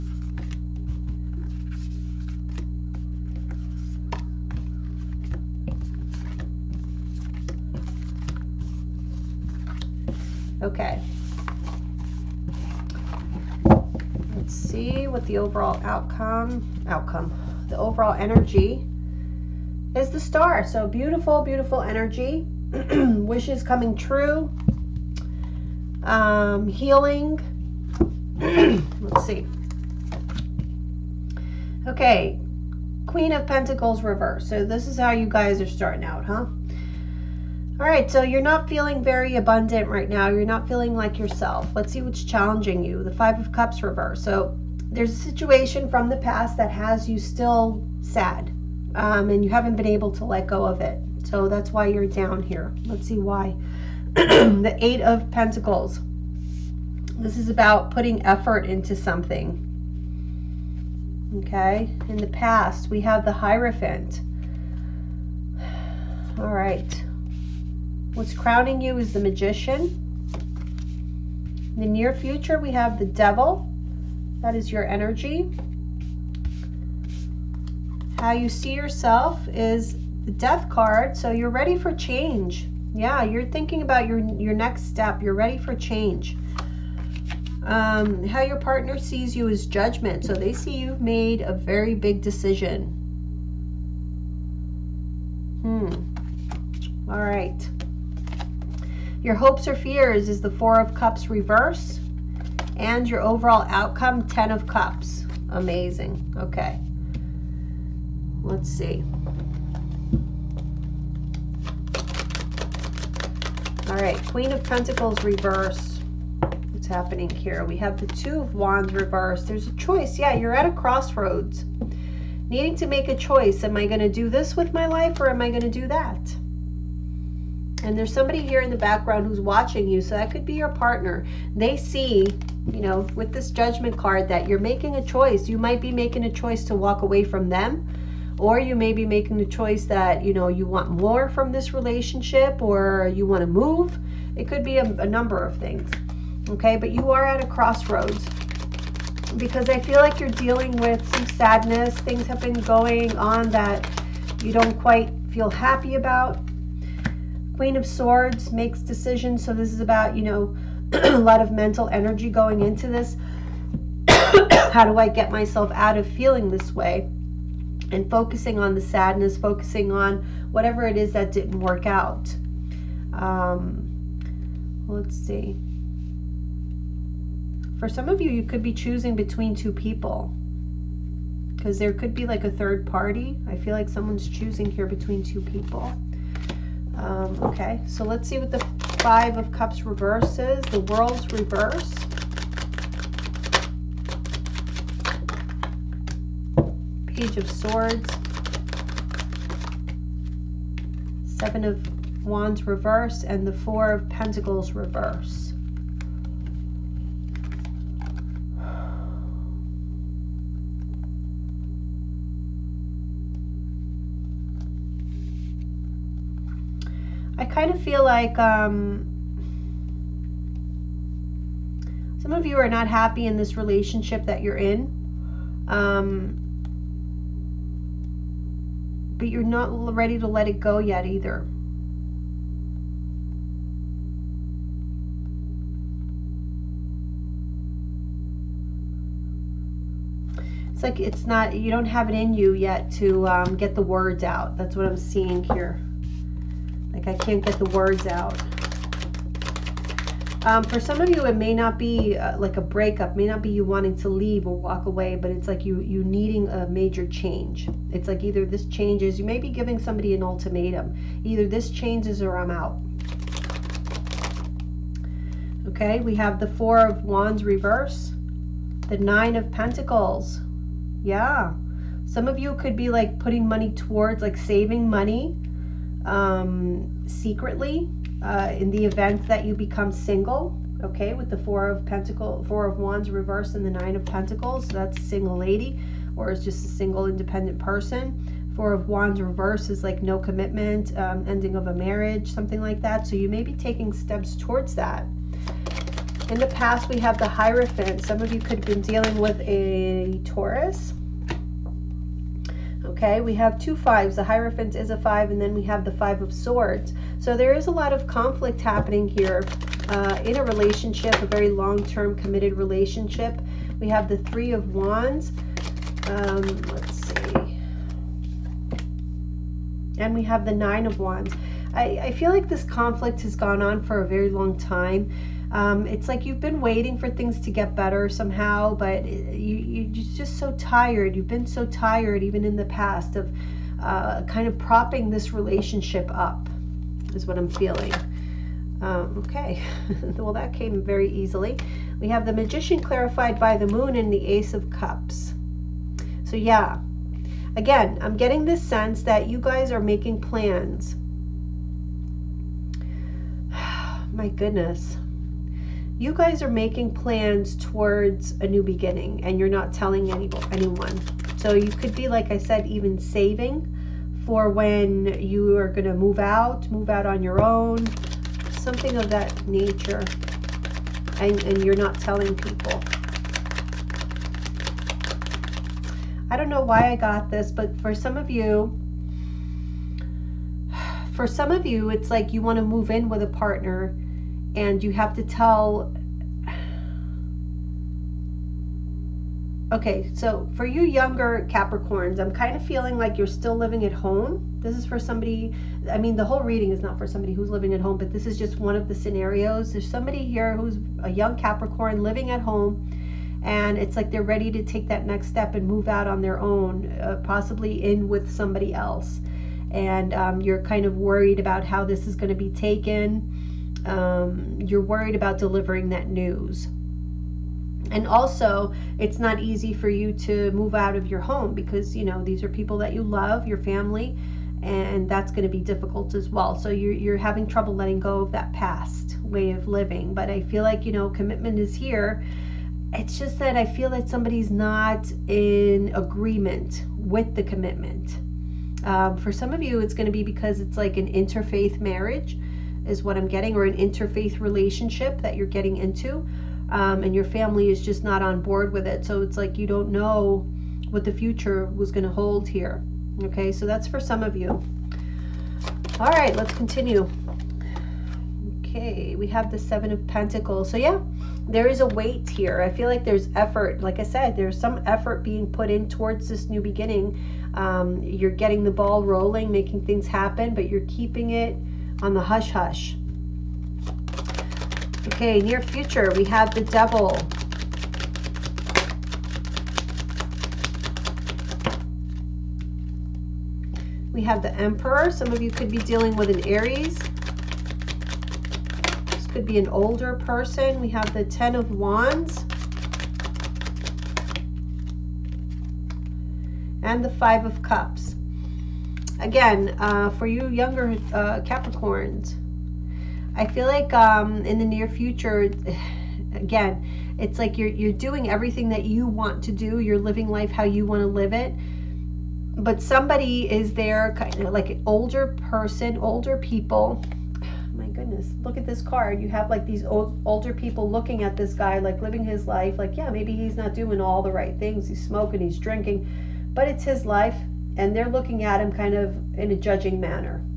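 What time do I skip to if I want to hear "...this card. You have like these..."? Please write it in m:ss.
8:38.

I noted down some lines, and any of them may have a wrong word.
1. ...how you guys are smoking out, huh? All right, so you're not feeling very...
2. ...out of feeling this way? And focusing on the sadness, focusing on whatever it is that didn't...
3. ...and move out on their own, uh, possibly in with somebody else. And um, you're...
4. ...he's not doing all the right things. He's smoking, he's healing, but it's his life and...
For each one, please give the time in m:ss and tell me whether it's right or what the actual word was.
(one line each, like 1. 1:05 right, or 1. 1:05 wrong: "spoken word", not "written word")
1. 0:34 wrong: "starting", not "smoking"
2. 2:45 right
3. 6:45 right
4. 8:43 wrong: "drinking", not "healing".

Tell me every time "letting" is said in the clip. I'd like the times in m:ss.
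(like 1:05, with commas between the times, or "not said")
7:07.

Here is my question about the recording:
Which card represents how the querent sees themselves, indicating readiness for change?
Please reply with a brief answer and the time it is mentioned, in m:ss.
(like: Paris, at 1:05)
Death, at 1:20.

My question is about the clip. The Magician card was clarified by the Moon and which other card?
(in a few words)
Ace of Cups.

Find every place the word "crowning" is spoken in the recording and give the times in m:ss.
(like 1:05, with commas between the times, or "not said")
1:08.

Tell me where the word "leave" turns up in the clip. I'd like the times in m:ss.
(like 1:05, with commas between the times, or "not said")
4:14.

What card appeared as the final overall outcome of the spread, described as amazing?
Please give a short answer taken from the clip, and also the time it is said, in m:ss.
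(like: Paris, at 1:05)
Ten of Cups, at 1:44.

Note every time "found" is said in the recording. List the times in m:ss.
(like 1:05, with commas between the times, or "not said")
not said.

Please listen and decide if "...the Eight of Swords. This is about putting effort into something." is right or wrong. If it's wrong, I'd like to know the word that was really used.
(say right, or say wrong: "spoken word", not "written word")
wrong: "Pentacles", not "Swords".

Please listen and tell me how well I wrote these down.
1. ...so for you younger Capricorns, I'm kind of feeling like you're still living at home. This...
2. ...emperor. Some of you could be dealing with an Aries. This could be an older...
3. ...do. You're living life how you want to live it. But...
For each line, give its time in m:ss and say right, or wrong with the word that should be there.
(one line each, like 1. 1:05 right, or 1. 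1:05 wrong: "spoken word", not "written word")
1. 6:30 right
2. 8:04 right
3. 8:29 right.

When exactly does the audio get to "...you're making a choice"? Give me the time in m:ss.
2:14.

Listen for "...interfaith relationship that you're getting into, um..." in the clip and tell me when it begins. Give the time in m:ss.
7:23.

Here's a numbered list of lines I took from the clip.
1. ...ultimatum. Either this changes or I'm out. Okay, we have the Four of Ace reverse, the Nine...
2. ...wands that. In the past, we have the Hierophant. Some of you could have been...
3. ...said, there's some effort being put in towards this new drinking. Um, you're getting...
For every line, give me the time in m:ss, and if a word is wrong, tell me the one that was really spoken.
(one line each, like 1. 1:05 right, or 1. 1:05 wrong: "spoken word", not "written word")
1. 4:20 wrong: "Wands", not "Ace"
2. 4:54 wrong: "towards", not "wands"
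3. 7:44 wrong: "beginning", not "drinking".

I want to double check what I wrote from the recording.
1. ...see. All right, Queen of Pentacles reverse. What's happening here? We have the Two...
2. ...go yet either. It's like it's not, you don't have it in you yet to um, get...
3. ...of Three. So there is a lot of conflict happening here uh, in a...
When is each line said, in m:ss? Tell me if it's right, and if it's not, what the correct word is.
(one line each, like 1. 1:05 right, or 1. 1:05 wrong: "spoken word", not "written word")
1. 1:48 right
2. 3:50 right
3. 5:06 wrong: "Swords", not "Three".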